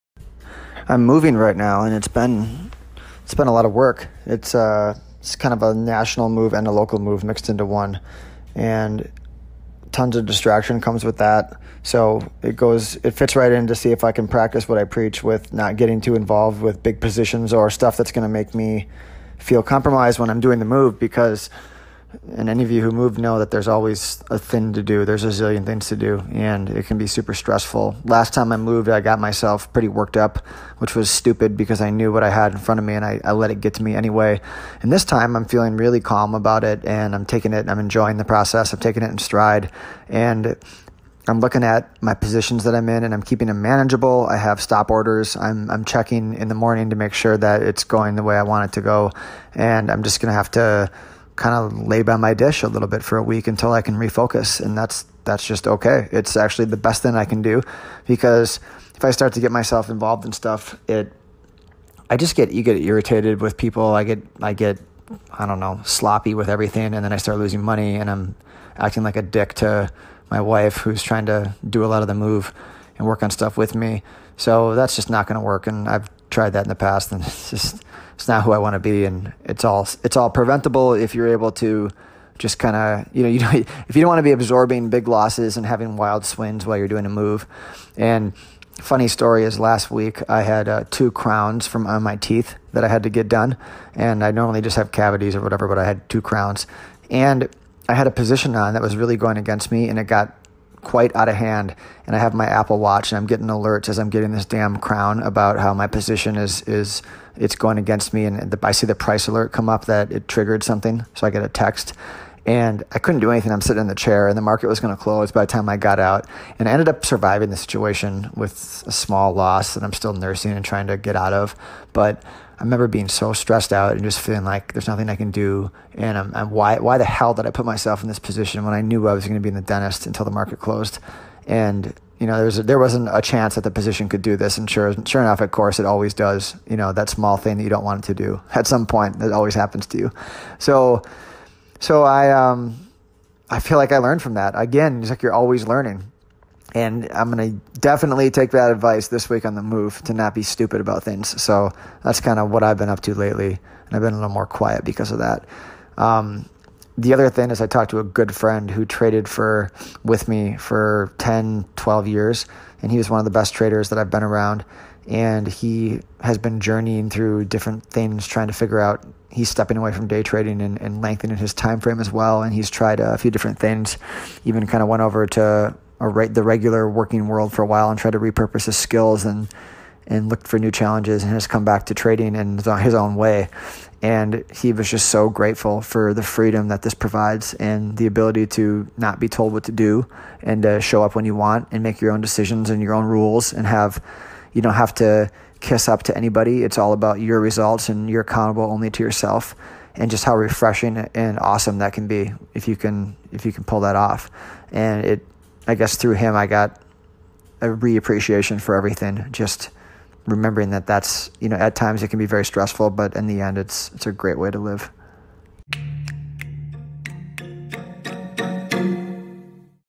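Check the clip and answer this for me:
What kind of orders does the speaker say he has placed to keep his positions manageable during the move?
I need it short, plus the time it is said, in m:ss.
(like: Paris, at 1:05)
Stop orders, at 0:44.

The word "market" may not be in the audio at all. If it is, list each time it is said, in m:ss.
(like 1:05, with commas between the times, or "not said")
1:54, 2:10.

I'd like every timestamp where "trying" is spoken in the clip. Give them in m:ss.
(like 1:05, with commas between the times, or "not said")
1:11, 2:00, 2:48.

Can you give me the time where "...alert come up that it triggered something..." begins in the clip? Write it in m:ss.
1:49.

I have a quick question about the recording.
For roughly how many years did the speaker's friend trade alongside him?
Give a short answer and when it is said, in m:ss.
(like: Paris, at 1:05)
10 to 12 years, at 2:41.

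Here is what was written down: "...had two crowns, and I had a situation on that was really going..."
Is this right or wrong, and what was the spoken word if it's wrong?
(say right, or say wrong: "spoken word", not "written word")
wrong: "position", not "situation".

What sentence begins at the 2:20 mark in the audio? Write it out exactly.
So so I, um, I feel like I learned from that.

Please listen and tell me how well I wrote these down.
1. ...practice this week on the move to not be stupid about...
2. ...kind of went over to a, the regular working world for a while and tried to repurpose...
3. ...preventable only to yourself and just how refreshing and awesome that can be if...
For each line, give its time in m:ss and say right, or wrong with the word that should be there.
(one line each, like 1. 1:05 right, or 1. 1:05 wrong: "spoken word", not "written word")
1. 2:28 wrong: "advice", not "practice"
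2. 2:54 right
3. 3:18 wrong: "accountable", not "preventable".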